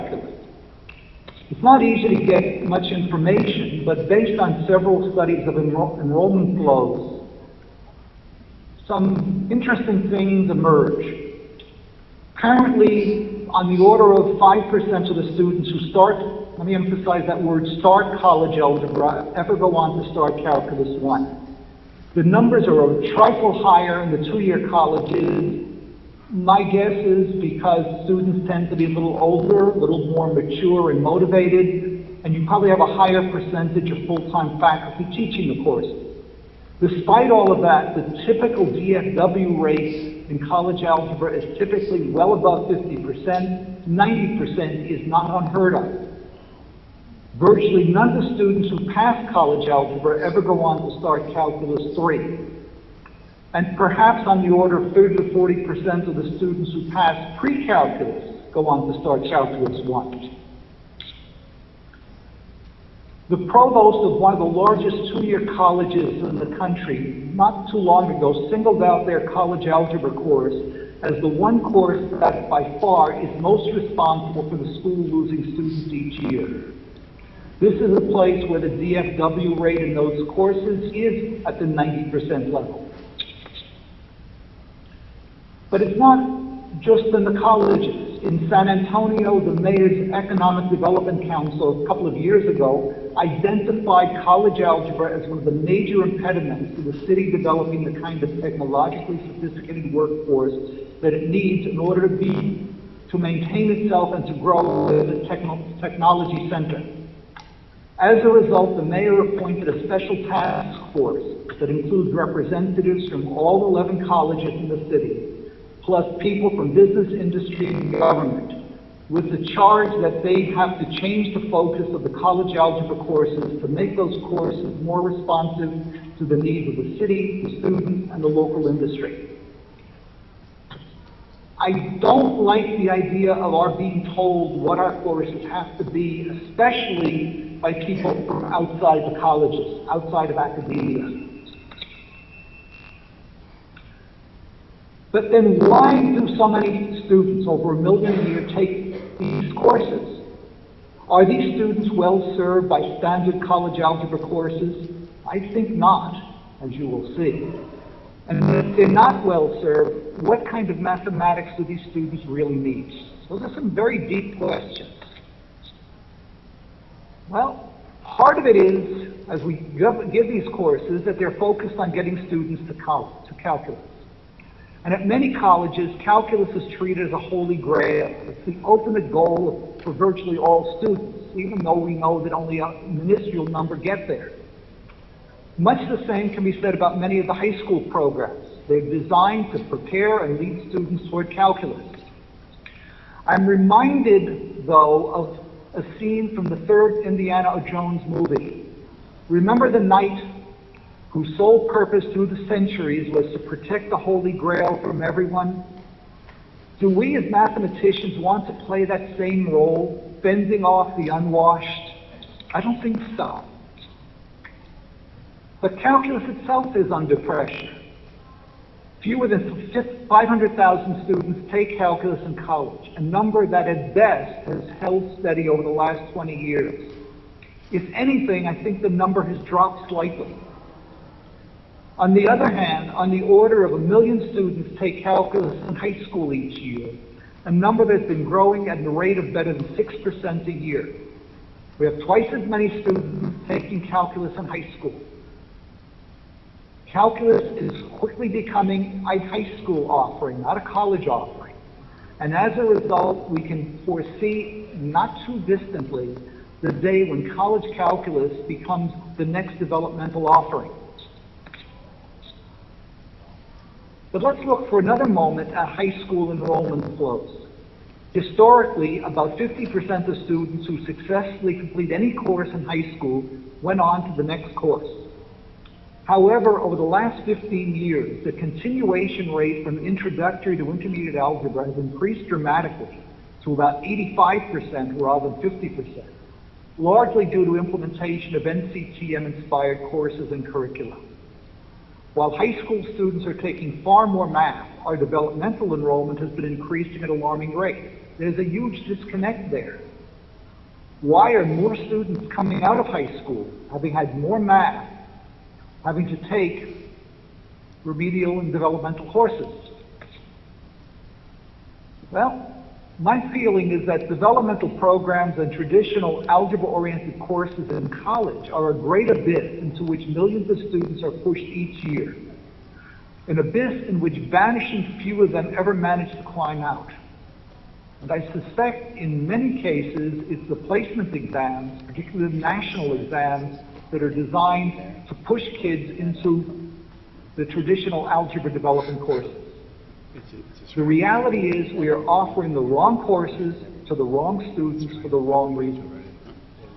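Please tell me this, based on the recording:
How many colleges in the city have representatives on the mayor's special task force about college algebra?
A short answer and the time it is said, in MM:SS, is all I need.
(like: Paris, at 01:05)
11, at 01:53.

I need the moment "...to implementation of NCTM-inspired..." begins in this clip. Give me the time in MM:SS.
04:47.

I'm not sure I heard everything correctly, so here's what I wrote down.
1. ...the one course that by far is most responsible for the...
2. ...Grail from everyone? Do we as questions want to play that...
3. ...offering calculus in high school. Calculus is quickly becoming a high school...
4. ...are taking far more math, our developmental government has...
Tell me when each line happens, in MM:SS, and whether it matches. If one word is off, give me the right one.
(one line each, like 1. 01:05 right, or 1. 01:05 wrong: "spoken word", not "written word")
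1. 01:11 right
2. 03:24 wrong: "mathematicians", not "questions"
3. 04:03 wrong: "taking", not "offering"
4. 04:53 wrong: "enrollment", not "government".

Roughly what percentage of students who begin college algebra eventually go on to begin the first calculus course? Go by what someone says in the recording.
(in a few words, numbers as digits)
5%.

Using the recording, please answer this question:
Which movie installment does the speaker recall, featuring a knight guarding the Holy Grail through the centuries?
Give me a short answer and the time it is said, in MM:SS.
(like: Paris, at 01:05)
third Indiana Jones, at 03:16.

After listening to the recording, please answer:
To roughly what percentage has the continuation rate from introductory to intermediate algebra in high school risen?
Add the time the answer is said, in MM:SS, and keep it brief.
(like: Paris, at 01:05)
85%, at 04:43.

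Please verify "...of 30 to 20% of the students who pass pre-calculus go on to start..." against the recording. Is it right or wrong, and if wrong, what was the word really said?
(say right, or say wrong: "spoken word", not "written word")
wrong: "40", not "20".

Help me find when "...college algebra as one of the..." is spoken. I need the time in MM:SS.
01:34.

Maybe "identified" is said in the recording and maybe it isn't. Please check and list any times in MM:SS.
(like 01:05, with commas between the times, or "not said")
01:33.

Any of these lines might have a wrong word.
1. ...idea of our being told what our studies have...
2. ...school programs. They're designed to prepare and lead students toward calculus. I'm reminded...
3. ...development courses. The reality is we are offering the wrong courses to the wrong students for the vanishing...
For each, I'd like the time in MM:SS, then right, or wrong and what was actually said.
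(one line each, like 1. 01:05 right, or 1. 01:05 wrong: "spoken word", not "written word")
1. 02:12 wrong: "courses", not "studies"
2. 03:07 right
3. 05:38 wrong: "wrong", not "vanishing".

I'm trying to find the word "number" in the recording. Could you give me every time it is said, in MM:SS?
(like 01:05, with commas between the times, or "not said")
00:22, 03:03, 03:43, 03:48, 03:57.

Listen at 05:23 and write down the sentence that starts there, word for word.
An abyss in which vanishing few of them ever manage to climb out.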